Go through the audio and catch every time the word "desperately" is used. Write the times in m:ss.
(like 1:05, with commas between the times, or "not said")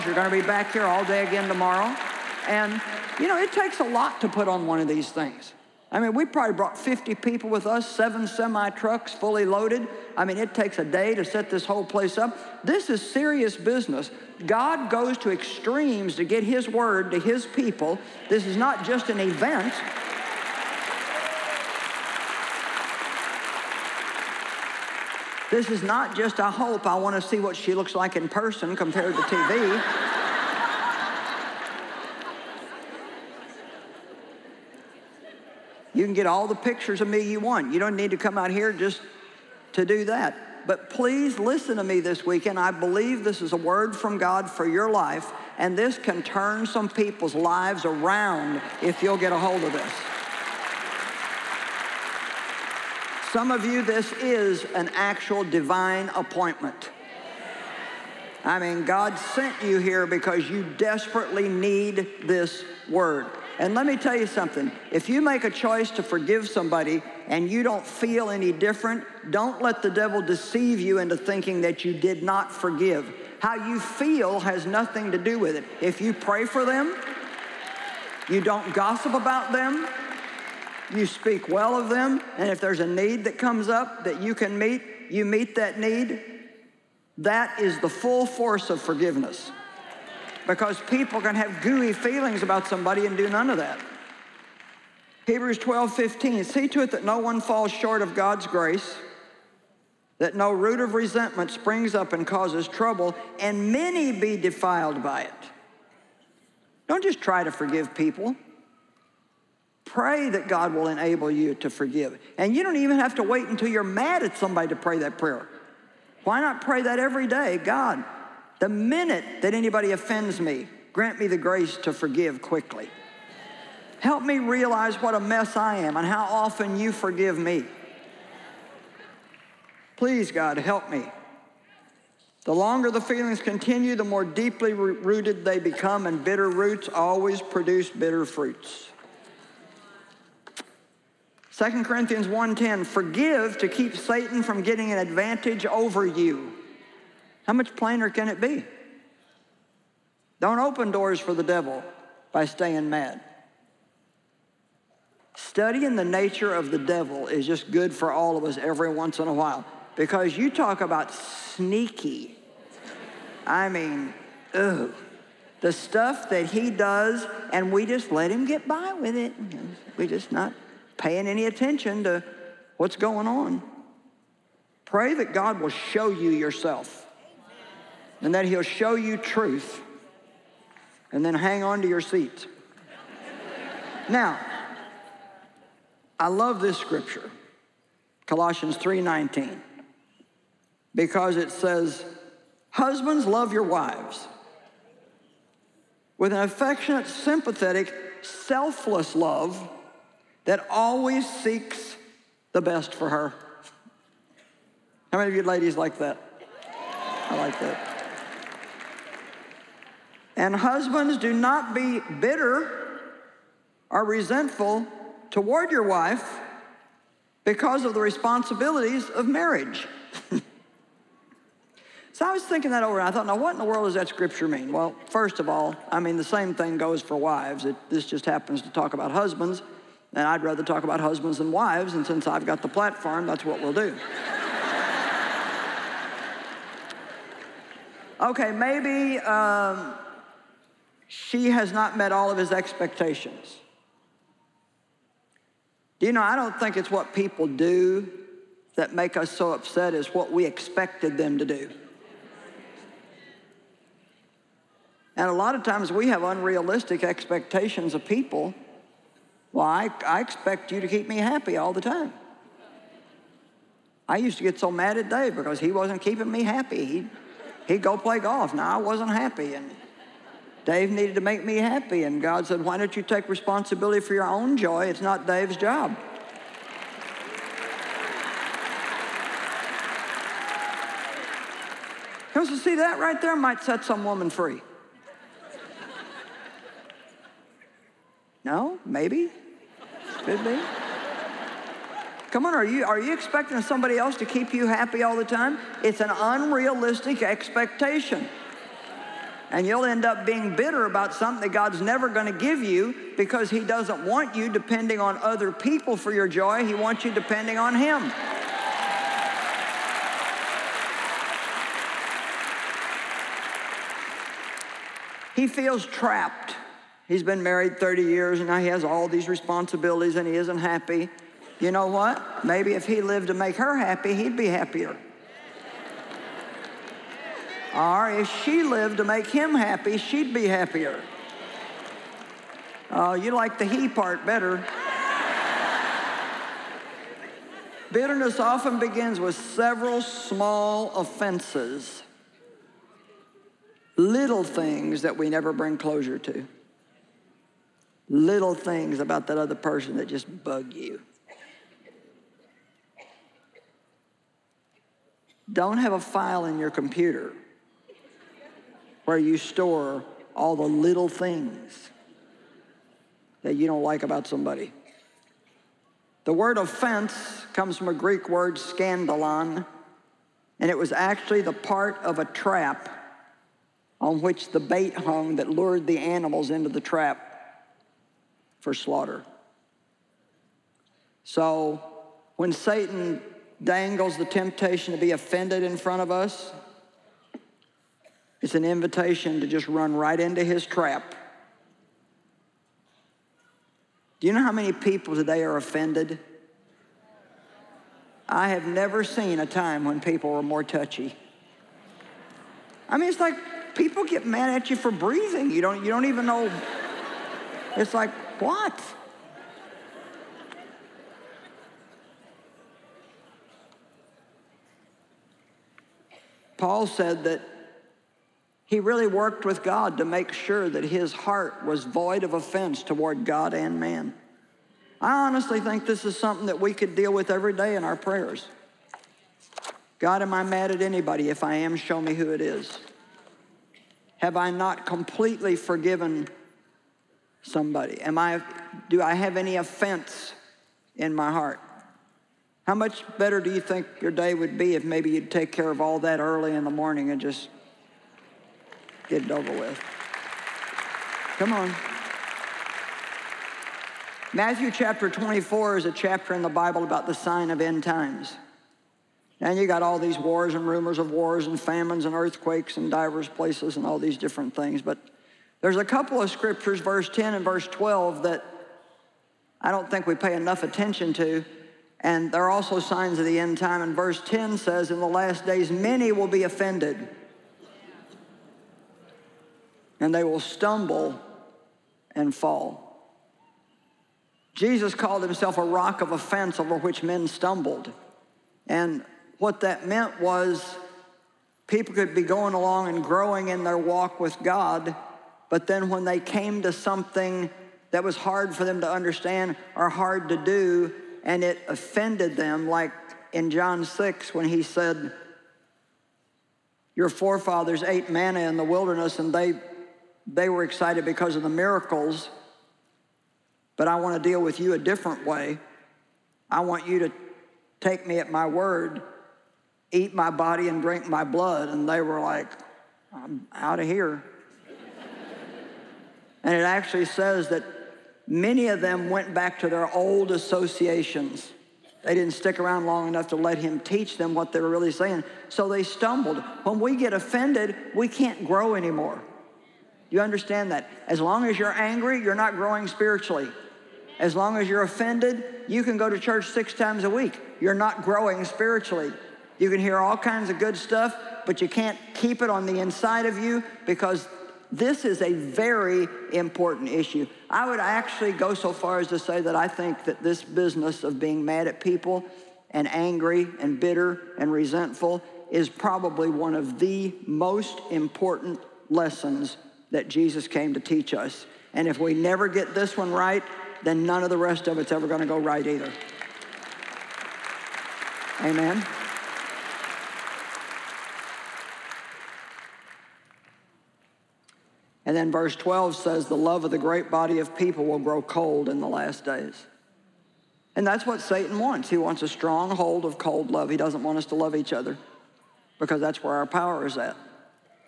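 1:00.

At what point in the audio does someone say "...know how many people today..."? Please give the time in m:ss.
6:34.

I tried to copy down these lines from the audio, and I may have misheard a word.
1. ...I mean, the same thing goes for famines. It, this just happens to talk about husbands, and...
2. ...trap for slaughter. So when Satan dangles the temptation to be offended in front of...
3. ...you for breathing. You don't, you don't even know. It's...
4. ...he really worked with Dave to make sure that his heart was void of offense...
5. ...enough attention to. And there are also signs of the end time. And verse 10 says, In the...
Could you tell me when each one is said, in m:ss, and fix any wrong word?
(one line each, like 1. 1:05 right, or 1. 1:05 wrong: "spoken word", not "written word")
1. 3:45 wrong: "wives", not "famines"
2. 6:16 right
3. 6:44 right
4. 6:58 wrong: "God", not "Dave"
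5. 7:50 right.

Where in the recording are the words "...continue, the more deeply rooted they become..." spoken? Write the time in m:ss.
2:13.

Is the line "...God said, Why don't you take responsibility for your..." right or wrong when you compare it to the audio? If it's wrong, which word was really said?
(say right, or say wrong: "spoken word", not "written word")
right.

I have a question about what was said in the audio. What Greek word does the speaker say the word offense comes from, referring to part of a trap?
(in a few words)
Scandalon.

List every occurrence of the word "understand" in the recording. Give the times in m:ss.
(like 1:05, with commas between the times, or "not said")
8:18, 9:00.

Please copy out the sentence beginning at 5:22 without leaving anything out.
Maybe if he lived to make her happy, he'd be happier.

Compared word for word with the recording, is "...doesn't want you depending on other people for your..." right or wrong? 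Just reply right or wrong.
right.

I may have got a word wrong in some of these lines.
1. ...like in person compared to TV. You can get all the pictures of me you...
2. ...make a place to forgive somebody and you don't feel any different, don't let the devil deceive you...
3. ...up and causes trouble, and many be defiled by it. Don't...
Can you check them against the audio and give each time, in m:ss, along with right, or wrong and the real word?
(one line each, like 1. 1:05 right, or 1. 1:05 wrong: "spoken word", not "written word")
1. 0:27 right
2. 1:05 wrong: "choice", not "place"
3. 1:41 right.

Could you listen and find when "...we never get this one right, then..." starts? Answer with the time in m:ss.
9:31.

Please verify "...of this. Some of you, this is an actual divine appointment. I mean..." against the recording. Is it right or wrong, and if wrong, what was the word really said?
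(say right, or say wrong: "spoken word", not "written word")
right.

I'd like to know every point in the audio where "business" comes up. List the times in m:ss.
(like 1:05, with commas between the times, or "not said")
0:13, 9:20.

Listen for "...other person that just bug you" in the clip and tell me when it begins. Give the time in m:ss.
5:49.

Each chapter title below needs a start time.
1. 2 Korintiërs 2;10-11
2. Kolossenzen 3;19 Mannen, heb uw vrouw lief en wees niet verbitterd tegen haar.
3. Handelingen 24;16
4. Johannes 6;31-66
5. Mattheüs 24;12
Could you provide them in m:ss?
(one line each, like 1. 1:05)
1. 2:15
2. 3:02
3. 6:49
4. 8:17
5. 9:38.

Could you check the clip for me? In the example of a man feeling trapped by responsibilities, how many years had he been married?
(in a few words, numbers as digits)
30.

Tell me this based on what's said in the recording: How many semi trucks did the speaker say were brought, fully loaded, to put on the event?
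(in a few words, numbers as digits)
7.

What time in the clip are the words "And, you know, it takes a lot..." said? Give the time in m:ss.
0:02.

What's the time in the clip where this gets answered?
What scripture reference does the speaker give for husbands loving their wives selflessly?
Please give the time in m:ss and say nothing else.
3:08.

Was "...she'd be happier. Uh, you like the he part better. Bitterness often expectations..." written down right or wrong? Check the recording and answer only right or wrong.
wrong.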